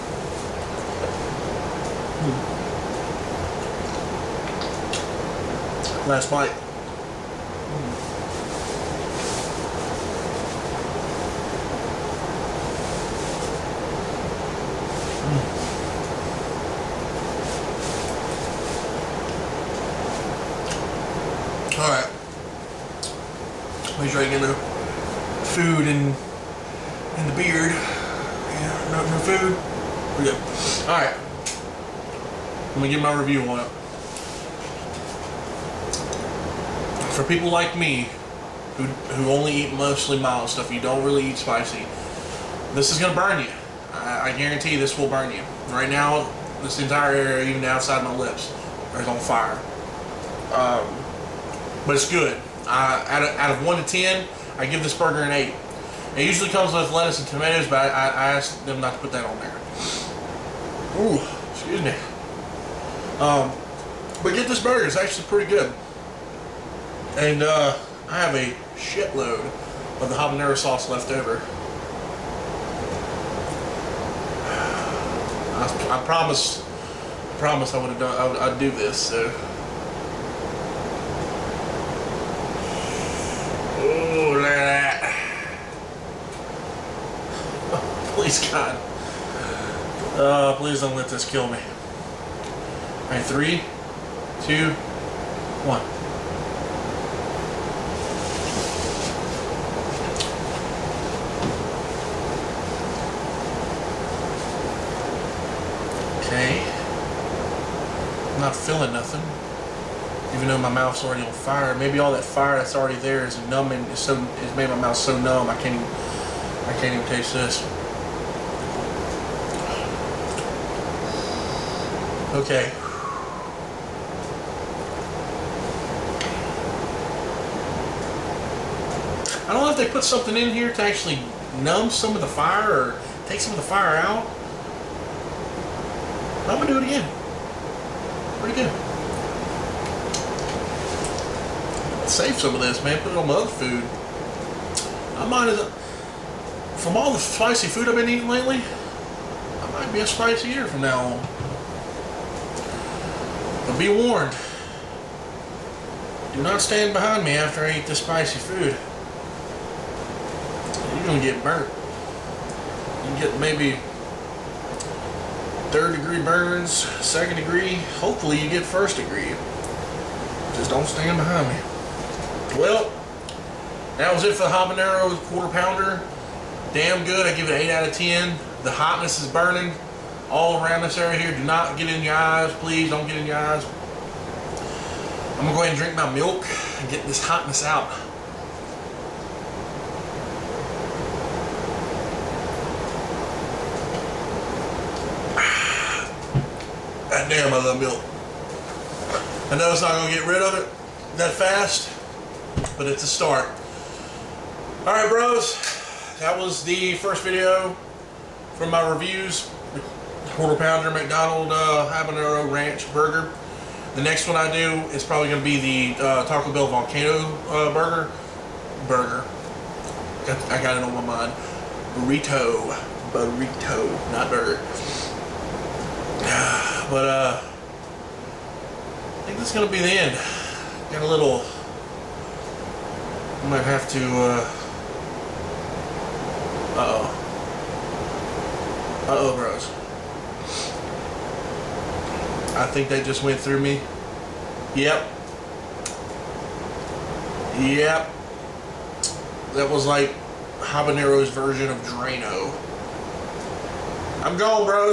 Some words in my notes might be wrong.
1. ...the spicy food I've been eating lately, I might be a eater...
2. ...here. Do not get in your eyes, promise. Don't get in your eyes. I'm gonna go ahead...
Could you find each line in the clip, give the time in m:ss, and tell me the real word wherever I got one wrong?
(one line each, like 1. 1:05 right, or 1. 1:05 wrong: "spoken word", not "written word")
1. 2:27 right
2. 3:01 wrong: "please", not "promise".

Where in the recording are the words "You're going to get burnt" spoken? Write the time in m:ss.
2:40.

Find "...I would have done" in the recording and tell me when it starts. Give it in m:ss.
1:17.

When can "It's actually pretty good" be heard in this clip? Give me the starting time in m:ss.
1:04.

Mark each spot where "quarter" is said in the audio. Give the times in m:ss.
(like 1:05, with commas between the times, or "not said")
2:55, 3:30.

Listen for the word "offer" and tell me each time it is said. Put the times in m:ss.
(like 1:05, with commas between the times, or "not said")
not said.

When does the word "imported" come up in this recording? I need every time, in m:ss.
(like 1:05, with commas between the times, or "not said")
not said.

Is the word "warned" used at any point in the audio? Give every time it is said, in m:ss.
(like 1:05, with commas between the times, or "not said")
2:33.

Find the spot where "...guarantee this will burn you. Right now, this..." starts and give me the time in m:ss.
0:44.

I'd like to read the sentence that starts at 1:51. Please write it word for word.
Maybe all that fire that's already there is numbing.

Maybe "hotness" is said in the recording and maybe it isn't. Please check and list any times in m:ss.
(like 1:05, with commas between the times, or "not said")
2:58, 3:07.